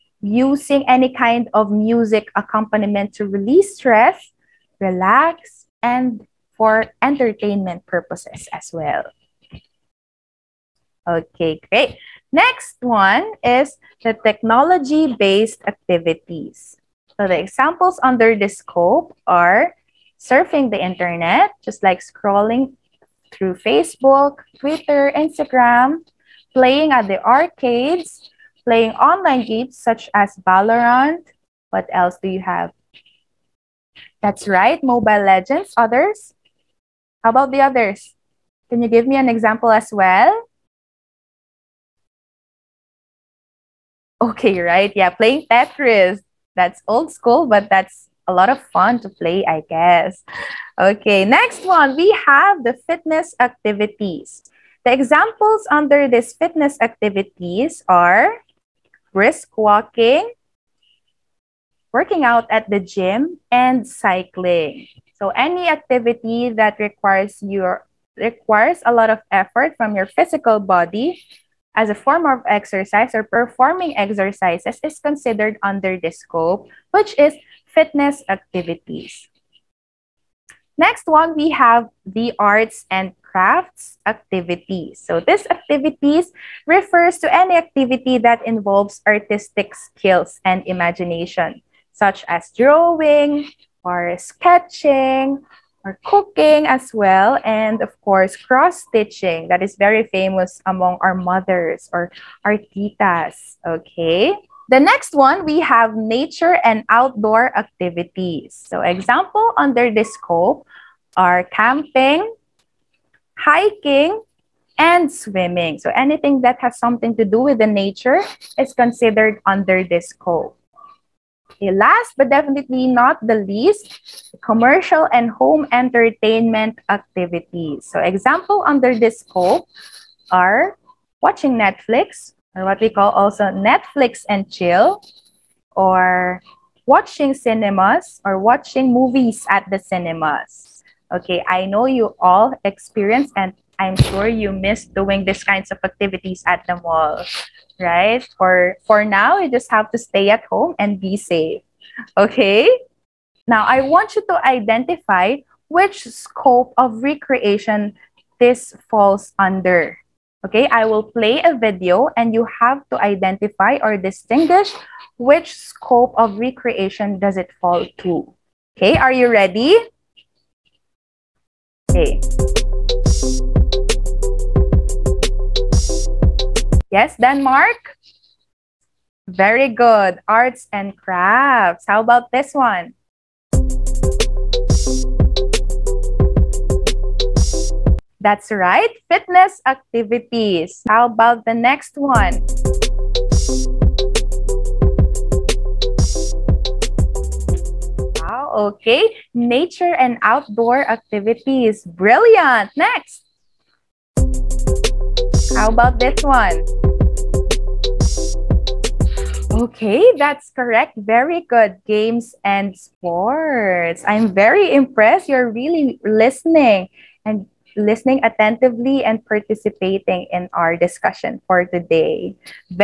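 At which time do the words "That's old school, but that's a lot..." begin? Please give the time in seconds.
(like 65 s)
46 s.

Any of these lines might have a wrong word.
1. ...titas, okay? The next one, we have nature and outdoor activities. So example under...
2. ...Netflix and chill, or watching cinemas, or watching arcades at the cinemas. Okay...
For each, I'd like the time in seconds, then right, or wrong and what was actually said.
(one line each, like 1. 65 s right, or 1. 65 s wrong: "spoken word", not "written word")
1. 102 s right
2. 133 s wrong: "movies", not "arcades".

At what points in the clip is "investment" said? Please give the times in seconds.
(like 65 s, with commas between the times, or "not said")
not said.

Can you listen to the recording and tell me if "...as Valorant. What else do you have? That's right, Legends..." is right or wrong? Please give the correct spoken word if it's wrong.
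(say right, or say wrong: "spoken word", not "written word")
wrong: "Mobile", not "Legends".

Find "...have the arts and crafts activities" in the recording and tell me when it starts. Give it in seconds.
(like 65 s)
81 s.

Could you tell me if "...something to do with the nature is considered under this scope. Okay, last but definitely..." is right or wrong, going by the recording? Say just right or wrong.
right.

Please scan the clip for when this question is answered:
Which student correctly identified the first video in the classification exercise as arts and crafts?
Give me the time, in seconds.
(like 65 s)
177 s.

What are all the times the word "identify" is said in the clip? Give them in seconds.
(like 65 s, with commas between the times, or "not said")
154 s, 162 s.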